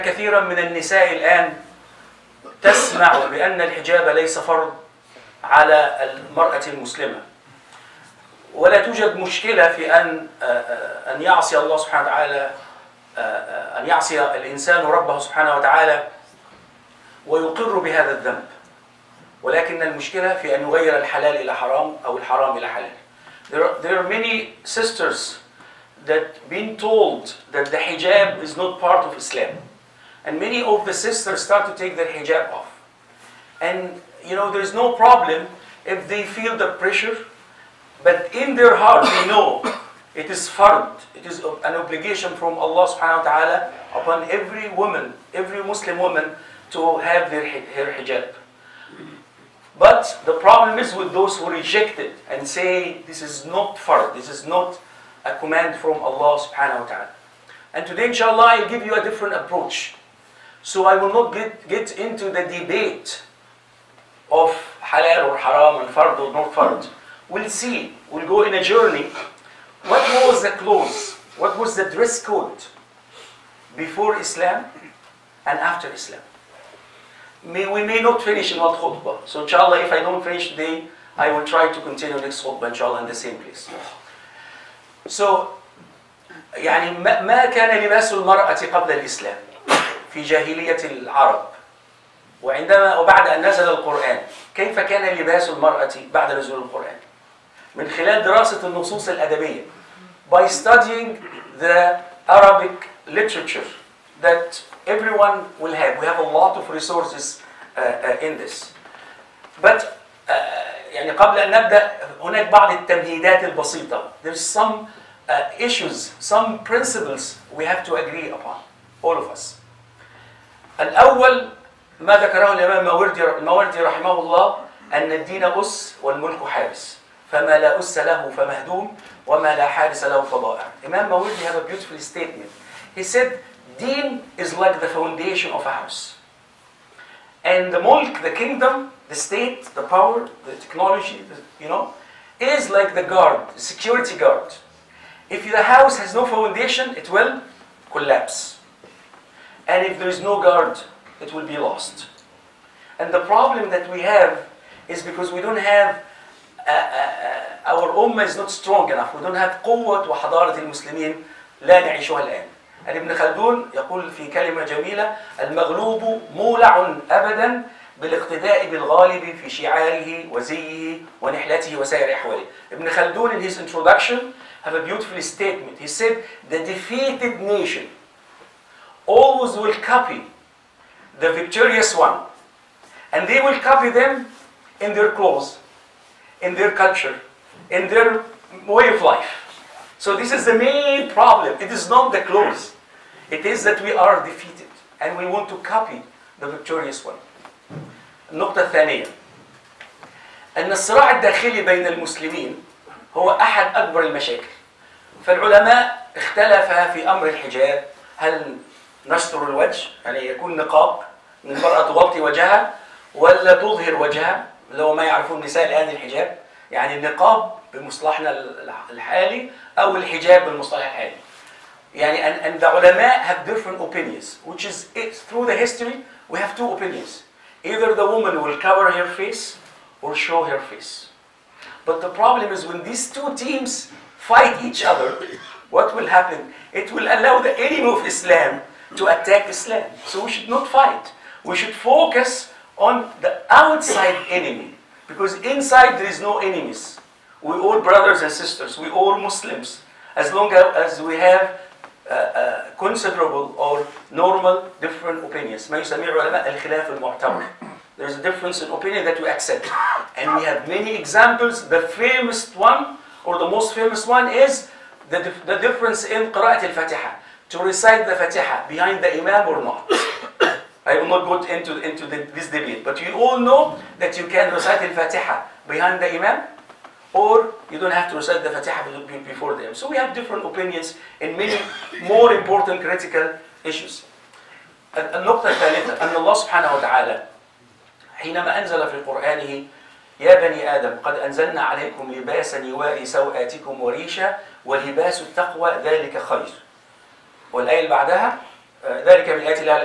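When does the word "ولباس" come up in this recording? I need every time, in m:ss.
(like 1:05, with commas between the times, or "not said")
4:54.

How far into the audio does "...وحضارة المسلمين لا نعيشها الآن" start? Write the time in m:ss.
2:40.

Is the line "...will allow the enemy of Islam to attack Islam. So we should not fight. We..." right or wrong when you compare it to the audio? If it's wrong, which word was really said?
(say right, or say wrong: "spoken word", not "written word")
right.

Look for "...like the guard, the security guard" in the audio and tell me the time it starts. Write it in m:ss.
2:22.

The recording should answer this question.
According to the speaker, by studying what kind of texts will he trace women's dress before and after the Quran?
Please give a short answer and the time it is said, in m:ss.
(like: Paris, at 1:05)
Arabic literature, at 1:42.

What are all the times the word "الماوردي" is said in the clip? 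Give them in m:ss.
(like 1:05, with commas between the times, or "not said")
2:03.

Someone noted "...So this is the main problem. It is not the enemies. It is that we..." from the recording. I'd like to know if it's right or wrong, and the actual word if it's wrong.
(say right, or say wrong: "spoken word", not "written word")
wrong: "clothes", not "enemies".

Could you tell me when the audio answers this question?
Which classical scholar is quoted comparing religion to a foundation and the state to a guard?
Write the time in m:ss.
2:10.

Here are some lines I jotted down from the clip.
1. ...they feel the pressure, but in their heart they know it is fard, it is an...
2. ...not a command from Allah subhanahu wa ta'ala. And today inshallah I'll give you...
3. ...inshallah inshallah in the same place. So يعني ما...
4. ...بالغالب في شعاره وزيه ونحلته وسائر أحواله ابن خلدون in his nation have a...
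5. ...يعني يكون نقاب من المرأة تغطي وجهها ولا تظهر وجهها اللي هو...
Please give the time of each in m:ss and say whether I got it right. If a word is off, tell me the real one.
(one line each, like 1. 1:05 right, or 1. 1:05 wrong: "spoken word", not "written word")
1. 0:36 right
2. 0:54 right
3. 1:22 wrong: "khutbah", not "inshallah"
4. 2:48 wrong: "introduction", not "nation"
5. 3:30 right.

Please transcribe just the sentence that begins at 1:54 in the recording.
There's some uh, issues, some principles we have to agree upon, all of us.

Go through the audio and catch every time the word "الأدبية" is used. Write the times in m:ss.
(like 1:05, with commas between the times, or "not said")
1:39.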